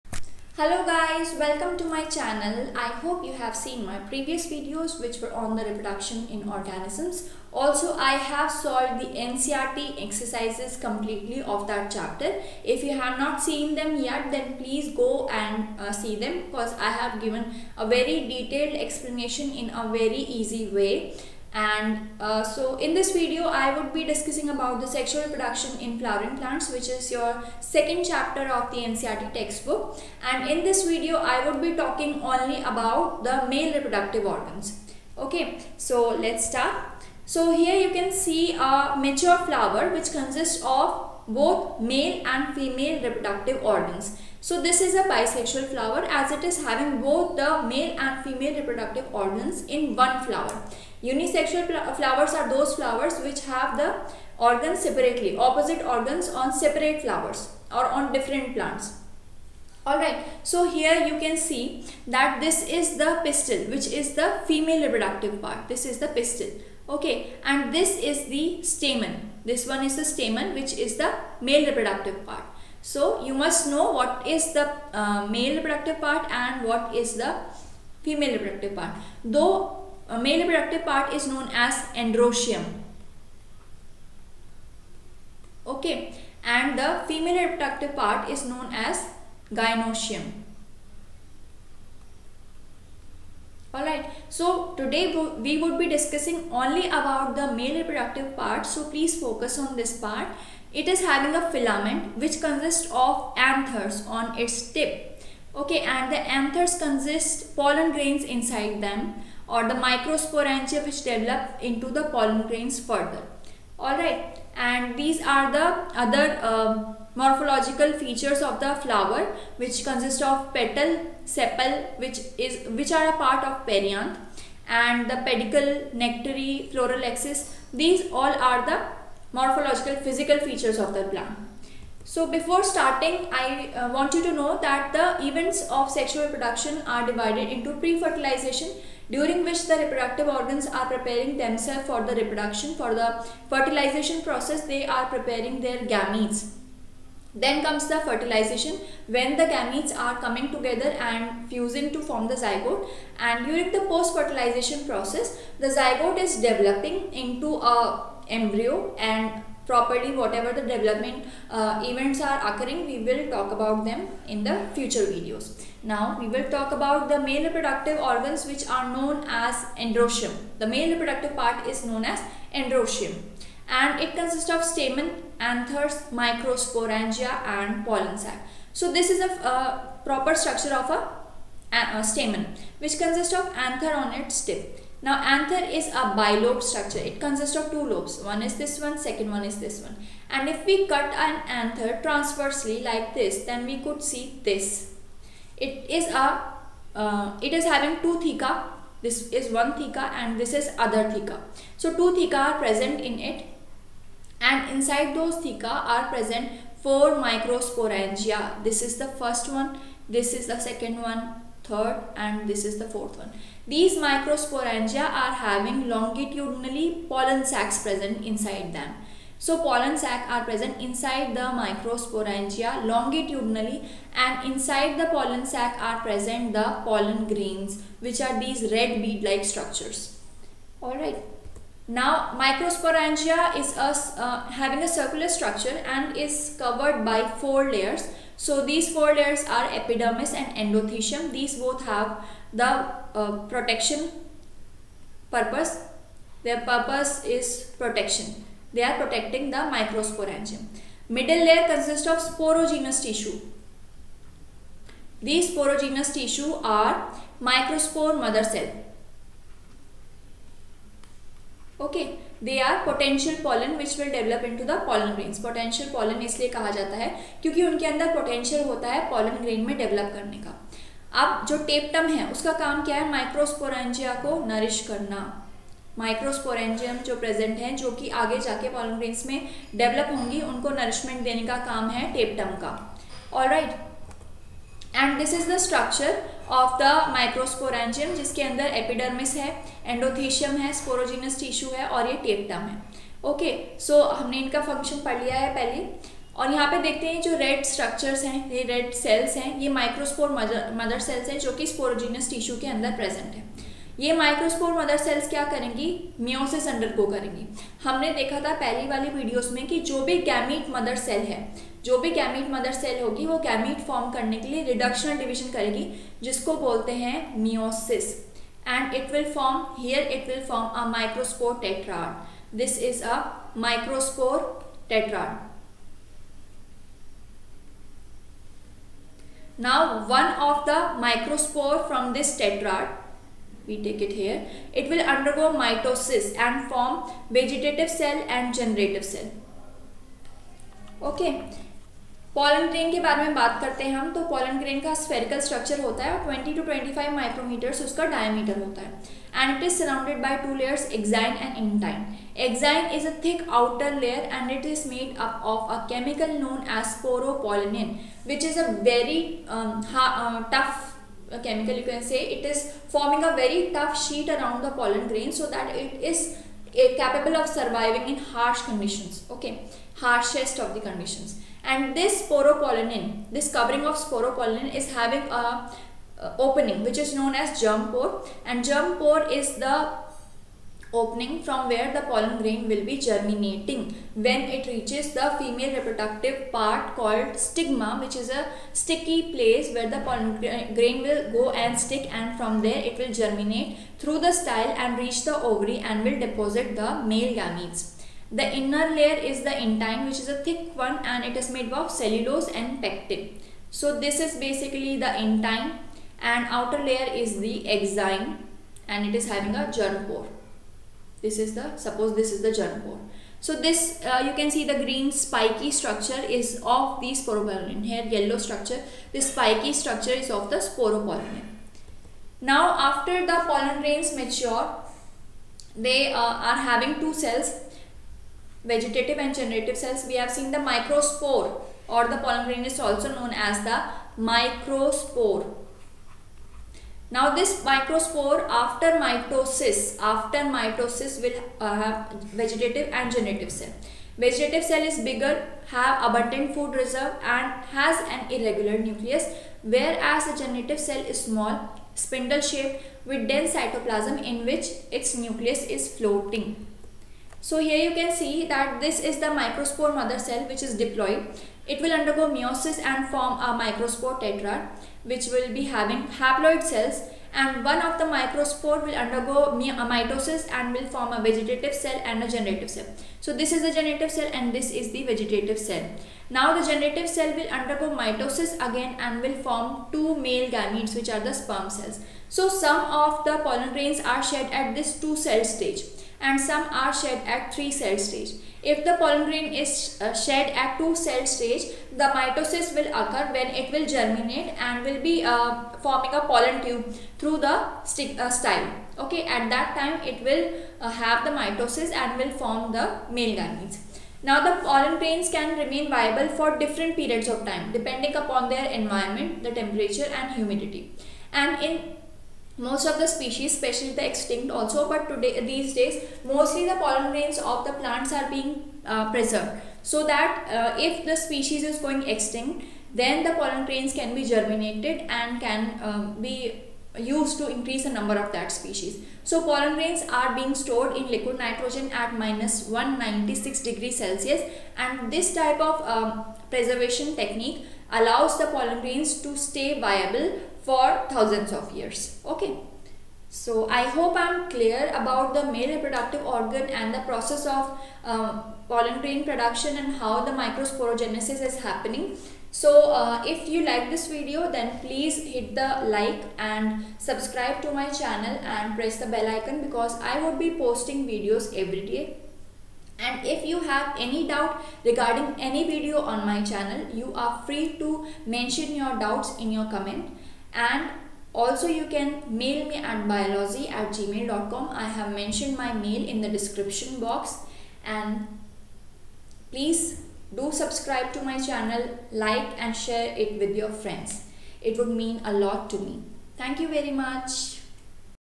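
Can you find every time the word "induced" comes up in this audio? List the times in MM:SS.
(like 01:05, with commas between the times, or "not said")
not said.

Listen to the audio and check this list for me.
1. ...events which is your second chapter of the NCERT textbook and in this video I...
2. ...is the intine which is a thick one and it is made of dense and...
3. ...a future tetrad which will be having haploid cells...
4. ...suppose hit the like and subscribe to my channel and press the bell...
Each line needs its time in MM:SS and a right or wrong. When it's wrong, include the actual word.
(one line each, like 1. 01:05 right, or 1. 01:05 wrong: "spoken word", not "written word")
1. 00:26 wrong: "plants", not "events"
2. 06:39 wrong: "cellulose", not "dense"
3. 07:43 wrong: "microspore", not "future"
4. 09:14 wrong: "please", not "suppose".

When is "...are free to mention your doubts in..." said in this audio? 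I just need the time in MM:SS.
09:27.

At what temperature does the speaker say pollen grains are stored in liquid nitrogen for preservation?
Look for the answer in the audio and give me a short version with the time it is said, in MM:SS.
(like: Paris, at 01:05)
-196 degrees Celsius, at 08:52.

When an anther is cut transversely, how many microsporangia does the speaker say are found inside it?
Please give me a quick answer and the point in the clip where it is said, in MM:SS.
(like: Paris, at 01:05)
4, at 03:26.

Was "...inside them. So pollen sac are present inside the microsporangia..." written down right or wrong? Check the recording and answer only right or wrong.
right.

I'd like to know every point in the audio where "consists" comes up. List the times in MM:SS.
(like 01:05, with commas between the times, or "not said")
00:40, 01:42, 01:46, 01:59, 02:54, 03:02, 03:07, 04:11.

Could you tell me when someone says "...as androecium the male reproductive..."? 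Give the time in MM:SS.
02:49.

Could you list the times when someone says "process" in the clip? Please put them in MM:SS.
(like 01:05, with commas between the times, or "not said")
02:24, 02:34, 09:06.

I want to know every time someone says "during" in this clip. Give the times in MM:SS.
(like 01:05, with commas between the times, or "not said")
02:19, 02:33.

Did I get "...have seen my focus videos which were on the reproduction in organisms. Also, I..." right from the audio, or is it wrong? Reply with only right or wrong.
wrong.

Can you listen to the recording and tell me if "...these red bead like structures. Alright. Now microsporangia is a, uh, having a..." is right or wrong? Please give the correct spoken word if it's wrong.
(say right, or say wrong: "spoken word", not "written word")
right.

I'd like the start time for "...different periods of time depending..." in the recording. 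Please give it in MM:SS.
08:26.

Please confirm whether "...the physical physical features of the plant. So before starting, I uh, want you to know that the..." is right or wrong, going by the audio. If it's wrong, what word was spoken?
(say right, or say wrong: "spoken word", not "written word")
wrong: "morphological", not "physical".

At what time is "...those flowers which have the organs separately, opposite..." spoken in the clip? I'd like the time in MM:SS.
00:52.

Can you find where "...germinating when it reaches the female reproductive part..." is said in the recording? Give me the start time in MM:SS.
06:22.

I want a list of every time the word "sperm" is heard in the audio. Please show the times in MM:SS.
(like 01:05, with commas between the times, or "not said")
08:01.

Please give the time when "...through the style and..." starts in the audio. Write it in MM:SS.
06:33.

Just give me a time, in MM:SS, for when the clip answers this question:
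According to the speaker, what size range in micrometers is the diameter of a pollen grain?
05:46.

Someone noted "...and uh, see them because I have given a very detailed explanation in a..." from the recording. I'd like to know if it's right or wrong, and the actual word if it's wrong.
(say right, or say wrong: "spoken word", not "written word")
right.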